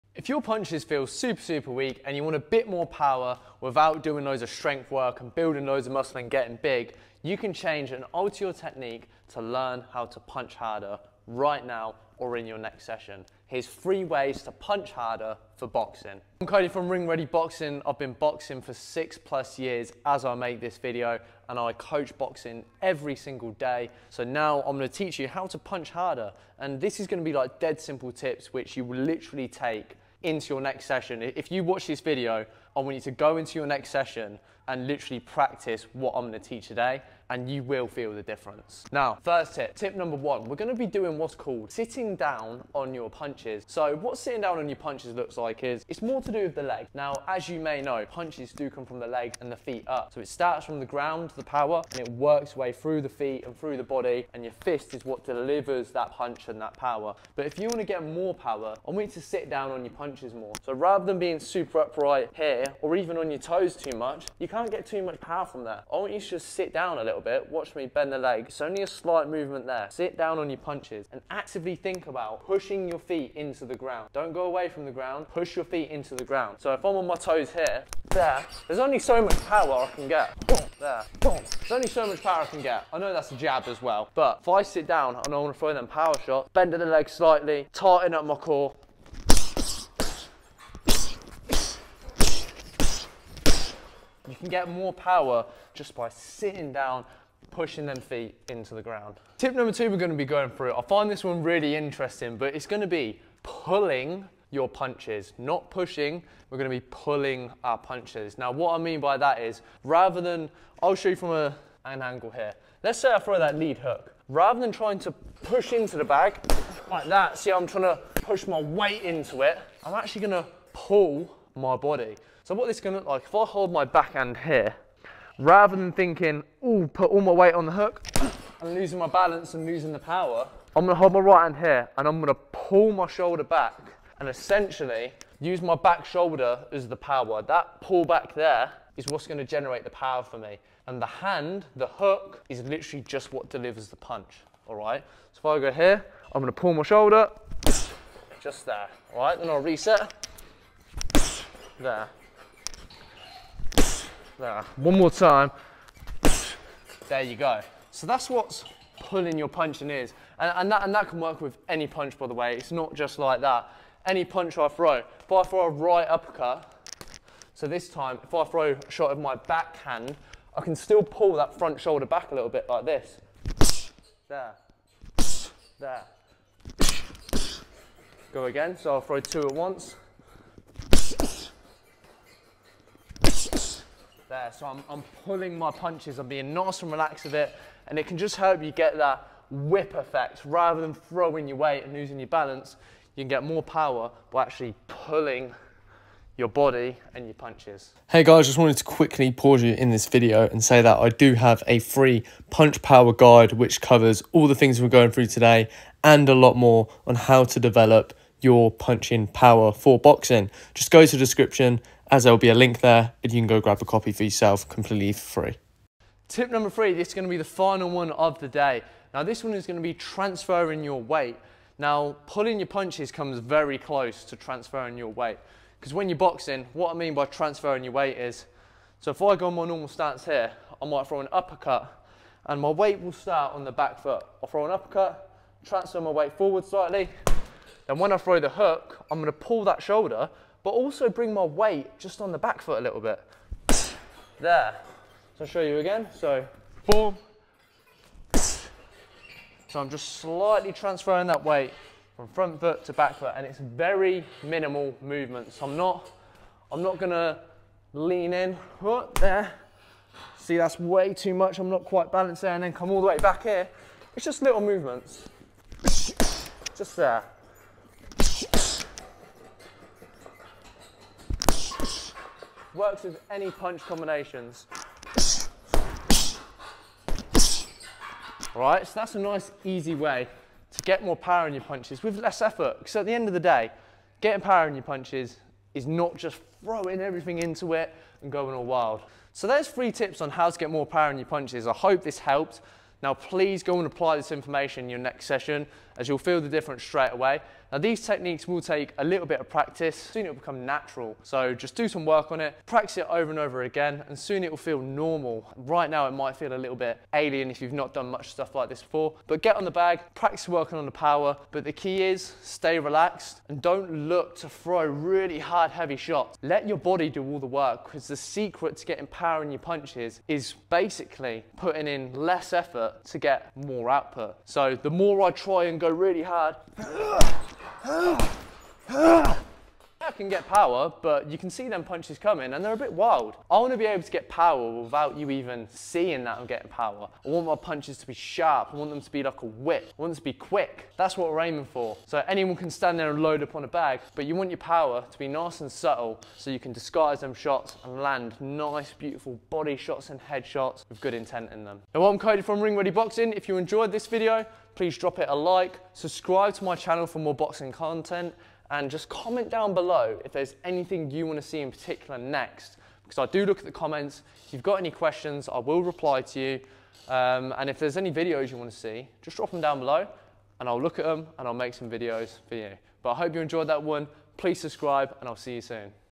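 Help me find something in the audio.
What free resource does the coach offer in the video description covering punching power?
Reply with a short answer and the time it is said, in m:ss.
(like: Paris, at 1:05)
Punch power guide, at 3:22.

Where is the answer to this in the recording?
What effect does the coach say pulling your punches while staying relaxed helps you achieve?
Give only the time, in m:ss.
3:09.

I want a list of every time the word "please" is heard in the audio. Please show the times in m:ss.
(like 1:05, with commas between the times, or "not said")
4:53, 5:54, 6:14.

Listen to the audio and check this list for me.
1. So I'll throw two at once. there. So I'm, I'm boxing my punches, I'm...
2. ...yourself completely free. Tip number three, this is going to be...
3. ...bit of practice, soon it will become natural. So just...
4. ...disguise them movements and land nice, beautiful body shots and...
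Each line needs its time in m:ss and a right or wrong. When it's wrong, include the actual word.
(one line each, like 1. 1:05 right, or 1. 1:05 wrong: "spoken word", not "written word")
1. 2:58 wrong: "pulling", not "boxing"
2. 3:34 right
3. 4:59 right
4. 5:46 wrong: "shots", not "movements".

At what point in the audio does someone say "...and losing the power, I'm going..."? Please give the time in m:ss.
2:09.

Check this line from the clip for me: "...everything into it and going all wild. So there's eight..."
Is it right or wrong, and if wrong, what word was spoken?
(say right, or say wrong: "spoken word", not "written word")
wrong: "three", not "eight".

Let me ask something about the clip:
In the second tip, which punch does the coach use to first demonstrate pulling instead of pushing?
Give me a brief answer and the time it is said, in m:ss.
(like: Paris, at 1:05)
Lead hook, at 1:53.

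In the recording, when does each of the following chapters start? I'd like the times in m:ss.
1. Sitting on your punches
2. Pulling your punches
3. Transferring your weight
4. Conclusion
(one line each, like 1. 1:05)
1. 0:39
2. 1:40
3. 3:37
4. 4:50.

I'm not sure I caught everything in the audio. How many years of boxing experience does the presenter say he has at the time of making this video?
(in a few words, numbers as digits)
6+.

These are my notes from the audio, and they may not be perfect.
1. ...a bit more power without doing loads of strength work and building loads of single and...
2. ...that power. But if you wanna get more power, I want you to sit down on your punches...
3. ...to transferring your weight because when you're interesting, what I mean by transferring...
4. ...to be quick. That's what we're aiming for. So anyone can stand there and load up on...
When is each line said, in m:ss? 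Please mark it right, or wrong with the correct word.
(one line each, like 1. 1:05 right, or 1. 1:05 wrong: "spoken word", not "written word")
1. 0:02 wrong: "muscle", not "single"
2. 0:56 right
3. 3:44 wrong: "boxing", not "interesting"
4. 5:40 right.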